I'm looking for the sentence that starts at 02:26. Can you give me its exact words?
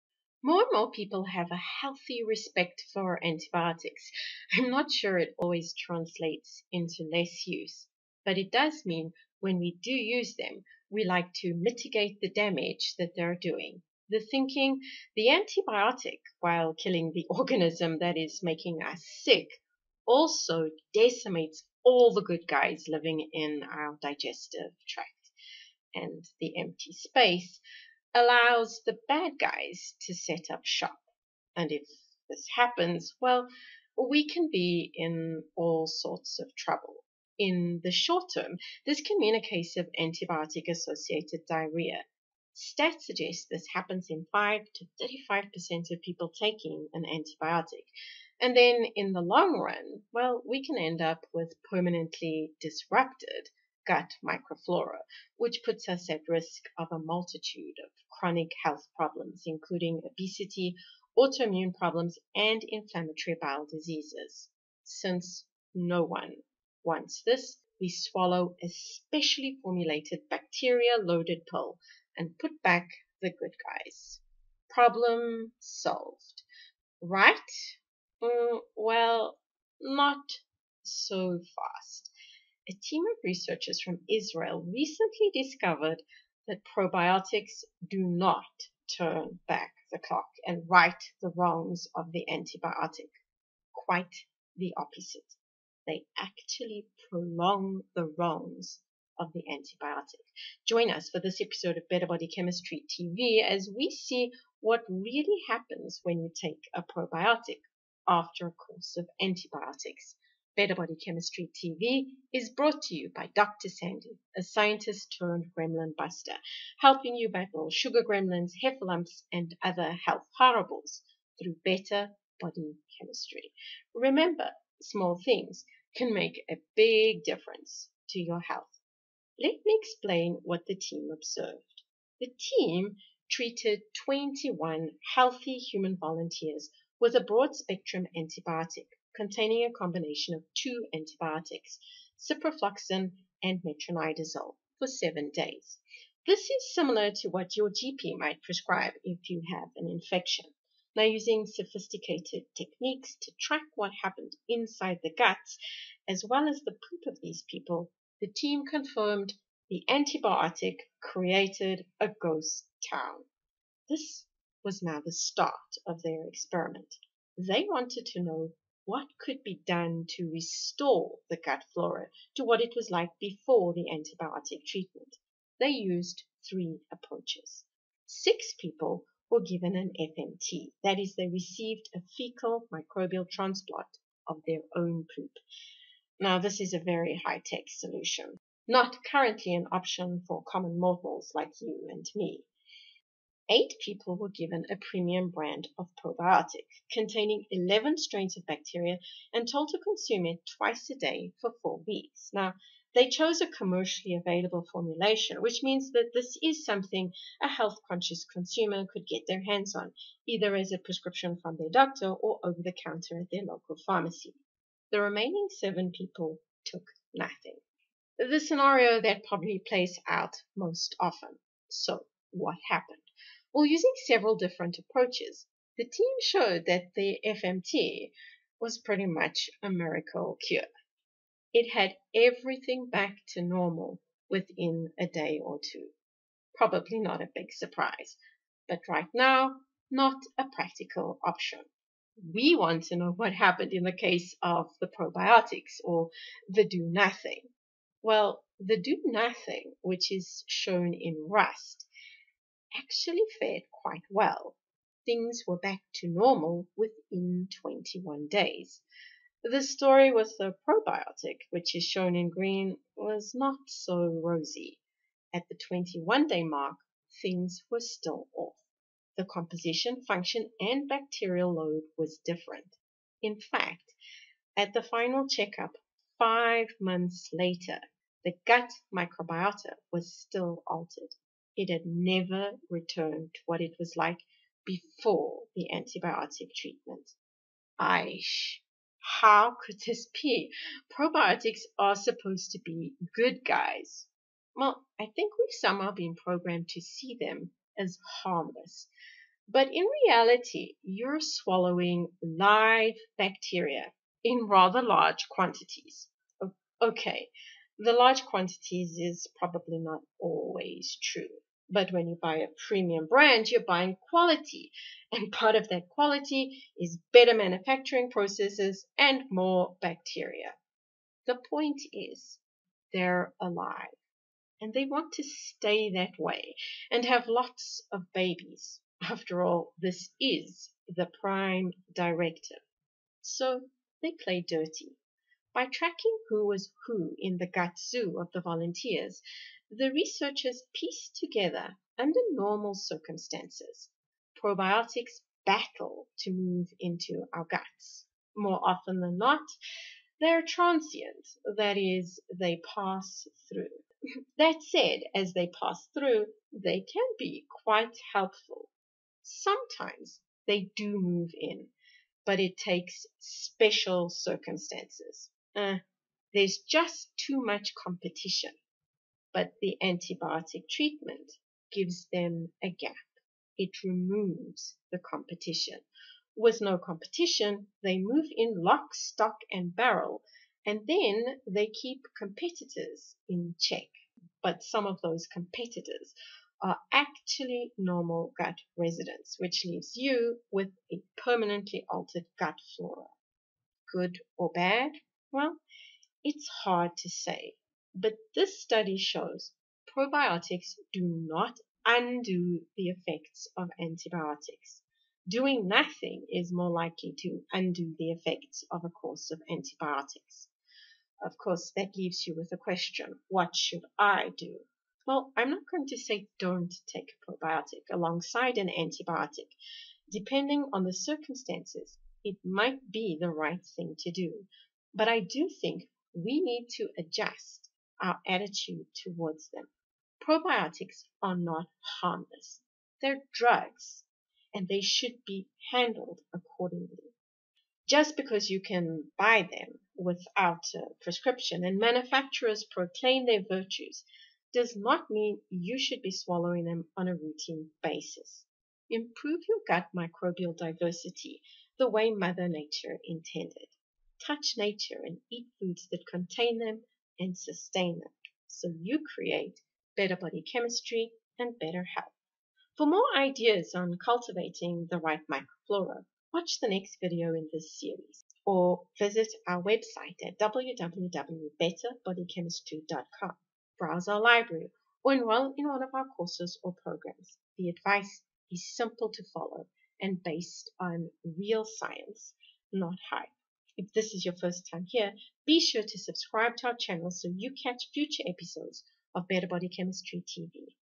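This is similar to what your GP might prescribe if you have an infection.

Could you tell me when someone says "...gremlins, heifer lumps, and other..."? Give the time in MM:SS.
01:58.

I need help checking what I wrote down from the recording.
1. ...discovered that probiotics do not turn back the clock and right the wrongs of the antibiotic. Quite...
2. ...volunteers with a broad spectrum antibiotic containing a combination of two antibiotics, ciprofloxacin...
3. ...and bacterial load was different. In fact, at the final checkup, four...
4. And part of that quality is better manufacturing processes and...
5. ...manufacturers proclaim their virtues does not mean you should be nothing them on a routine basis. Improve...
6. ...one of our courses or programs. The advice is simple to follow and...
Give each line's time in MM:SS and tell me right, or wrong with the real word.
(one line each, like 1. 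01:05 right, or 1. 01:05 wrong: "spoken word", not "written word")
1. 01:25 right
2. 02:15 right
3. 04:30 wrong: "five", not "four"
4. 05:15 right
5. 07:21 wrong: "swallowing", not "nothing"
6. 07:55 right.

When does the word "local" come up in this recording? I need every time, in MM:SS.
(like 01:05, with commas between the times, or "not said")
03:33.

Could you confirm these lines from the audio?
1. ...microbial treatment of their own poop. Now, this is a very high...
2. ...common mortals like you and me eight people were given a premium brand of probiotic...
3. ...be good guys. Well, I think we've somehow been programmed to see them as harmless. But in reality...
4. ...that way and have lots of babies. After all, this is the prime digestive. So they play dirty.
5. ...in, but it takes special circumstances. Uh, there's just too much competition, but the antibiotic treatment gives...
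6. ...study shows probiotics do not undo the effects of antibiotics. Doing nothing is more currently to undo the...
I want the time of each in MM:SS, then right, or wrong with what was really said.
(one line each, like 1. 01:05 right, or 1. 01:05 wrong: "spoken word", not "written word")
1. 03:02 wrong: "transplant", not "treatment"
2. 03:10 right
3. 04:52 right
4. 05:25 wrong: "directive", not "digestive"
5. 06:01 right
6. 06:38 wrong: "likely", not "currently".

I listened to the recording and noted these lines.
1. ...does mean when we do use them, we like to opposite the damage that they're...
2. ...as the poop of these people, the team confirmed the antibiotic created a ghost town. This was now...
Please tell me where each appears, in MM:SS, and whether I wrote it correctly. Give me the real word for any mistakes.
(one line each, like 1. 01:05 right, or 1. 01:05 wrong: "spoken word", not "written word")
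1. 00:08 wrong: "mitigate", not "opposite"
2. 02:36 right.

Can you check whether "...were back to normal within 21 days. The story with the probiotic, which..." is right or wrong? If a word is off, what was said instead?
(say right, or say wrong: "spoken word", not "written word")
right.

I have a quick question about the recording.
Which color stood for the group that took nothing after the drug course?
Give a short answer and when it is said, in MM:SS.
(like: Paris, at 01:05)
Rust, at 04:11.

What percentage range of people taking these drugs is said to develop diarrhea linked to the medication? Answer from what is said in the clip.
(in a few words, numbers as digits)
5 to 35%.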